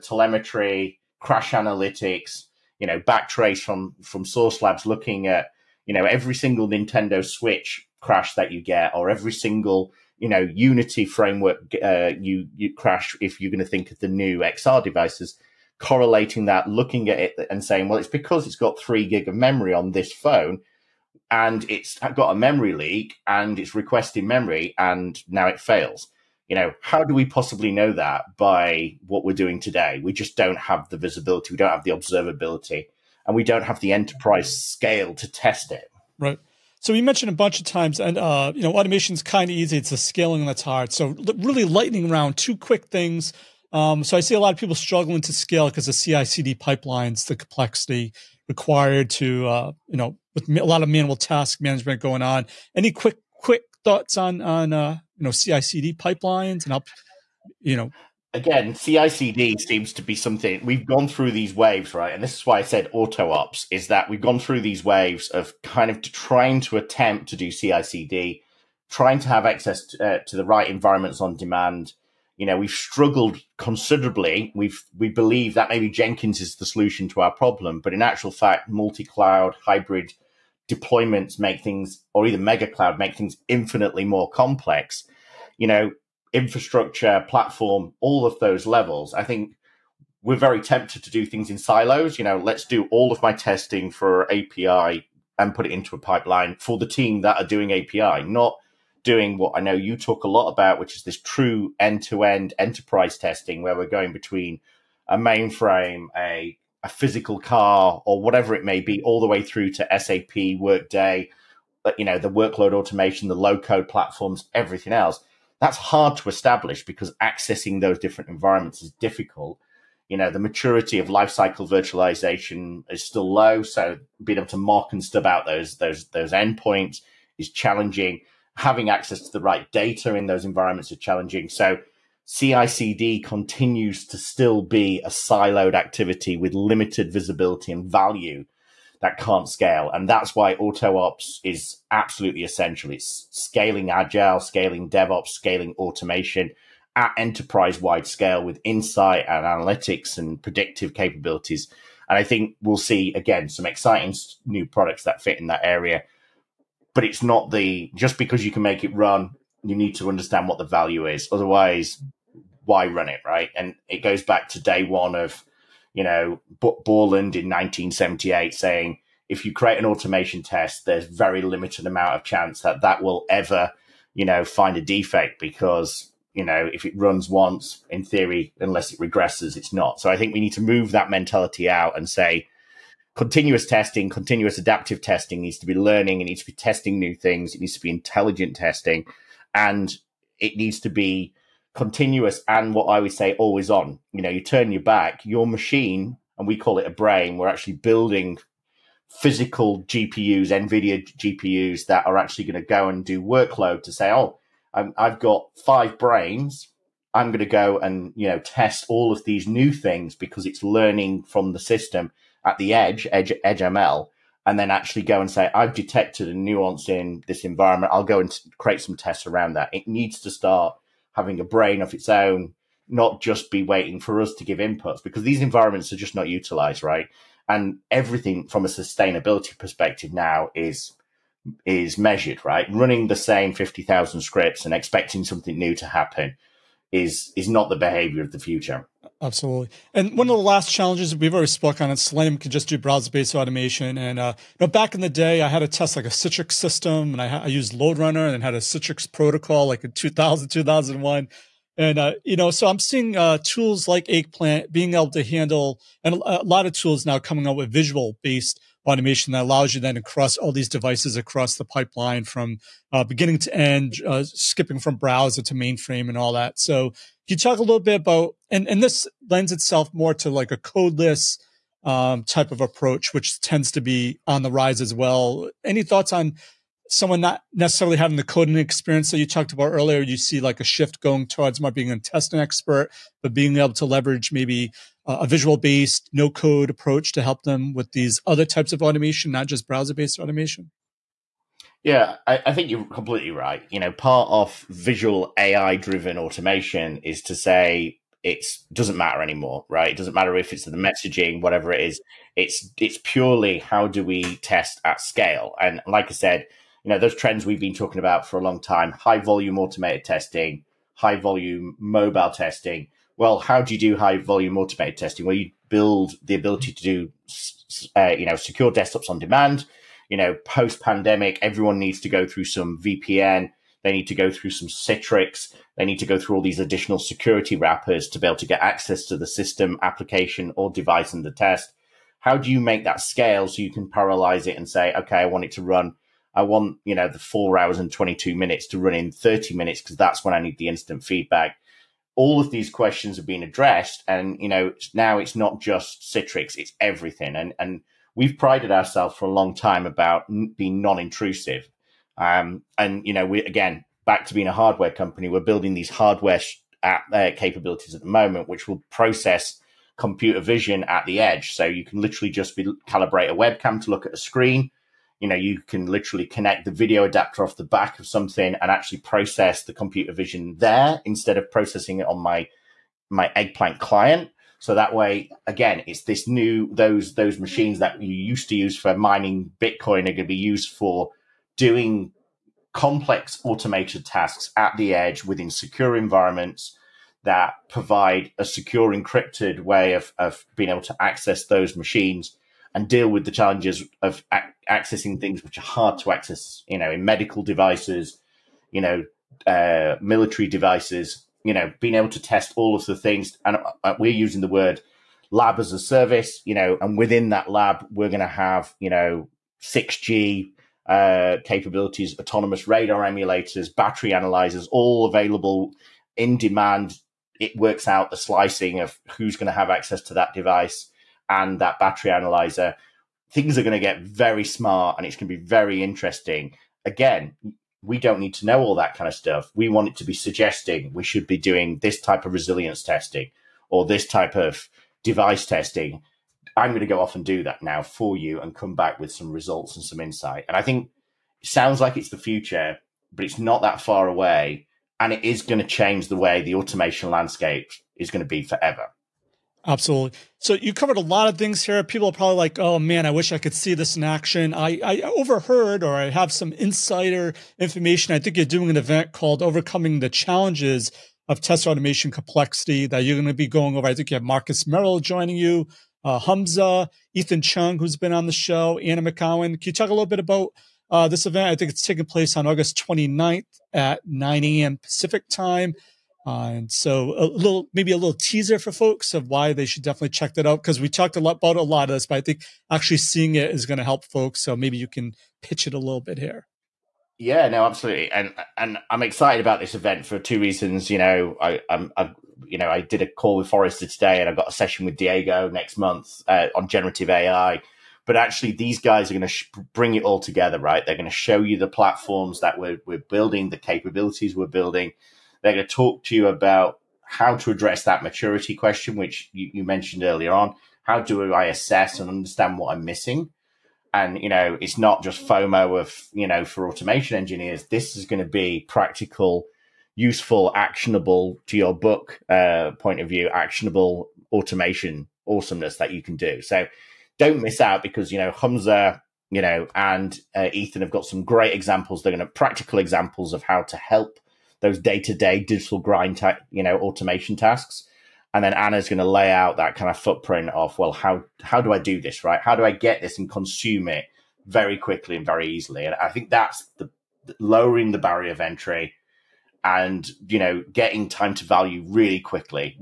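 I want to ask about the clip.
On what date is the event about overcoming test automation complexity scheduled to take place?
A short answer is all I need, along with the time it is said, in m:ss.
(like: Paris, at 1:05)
August 29, at 7:52.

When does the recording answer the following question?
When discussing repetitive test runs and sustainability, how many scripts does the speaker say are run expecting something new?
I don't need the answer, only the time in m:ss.
3:53.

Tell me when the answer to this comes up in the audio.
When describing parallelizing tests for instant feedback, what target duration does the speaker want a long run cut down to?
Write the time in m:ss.
5:39.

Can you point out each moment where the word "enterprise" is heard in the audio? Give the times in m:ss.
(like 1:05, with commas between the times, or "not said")
0:33, 1:42, 2:27.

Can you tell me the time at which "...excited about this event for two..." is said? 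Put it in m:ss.
8:09.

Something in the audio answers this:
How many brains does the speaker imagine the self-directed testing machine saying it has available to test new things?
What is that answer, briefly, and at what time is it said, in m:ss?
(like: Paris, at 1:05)
5, at 3:25.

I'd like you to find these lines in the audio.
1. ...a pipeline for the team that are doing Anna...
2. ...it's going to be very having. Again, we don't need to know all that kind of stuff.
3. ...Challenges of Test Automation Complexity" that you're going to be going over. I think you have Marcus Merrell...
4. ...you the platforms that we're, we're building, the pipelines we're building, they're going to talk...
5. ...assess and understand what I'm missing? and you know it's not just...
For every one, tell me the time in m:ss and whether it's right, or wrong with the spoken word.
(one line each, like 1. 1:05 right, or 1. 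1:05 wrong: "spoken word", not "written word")
1. 1:35 wrong: "API", not "Anna"
2. 7:05 wrong: "interesting", not "having"
3. 7:40 right
4. 8:21 wrong: "capabilities", not "pipelines"
5. 8:31 right.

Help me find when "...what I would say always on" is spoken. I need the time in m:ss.
3:12.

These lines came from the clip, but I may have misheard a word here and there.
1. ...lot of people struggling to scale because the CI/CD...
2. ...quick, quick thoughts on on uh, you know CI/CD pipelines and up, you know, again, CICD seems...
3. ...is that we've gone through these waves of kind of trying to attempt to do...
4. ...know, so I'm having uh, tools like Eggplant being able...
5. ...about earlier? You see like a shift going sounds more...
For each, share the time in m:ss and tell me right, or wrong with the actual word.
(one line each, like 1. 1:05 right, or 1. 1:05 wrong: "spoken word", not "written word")
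1. 0:44 right
2. 0:52 right
3. 1:03 right
4. 4:12 wrong: "seeing", not "having"
5. 4:39 wrong: "towards", not "sounds".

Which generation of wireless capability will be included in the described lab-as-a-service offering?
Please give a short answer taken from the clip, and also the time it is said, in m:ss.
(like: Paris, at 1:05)
6G, at 6:49.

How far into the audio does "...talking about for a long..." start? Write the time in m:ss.
5:07.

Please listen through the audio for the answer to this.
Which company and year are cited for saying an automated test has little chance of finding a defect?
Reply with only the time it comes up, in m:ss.
2:46.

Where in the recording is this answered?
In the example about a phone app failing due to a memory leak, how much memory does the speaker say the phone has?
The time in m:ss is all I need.
0:18.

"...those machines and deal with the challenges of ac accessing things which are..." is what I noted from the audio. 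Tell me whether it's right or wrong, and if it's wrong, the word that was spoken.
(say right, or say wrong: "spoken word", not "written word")
right.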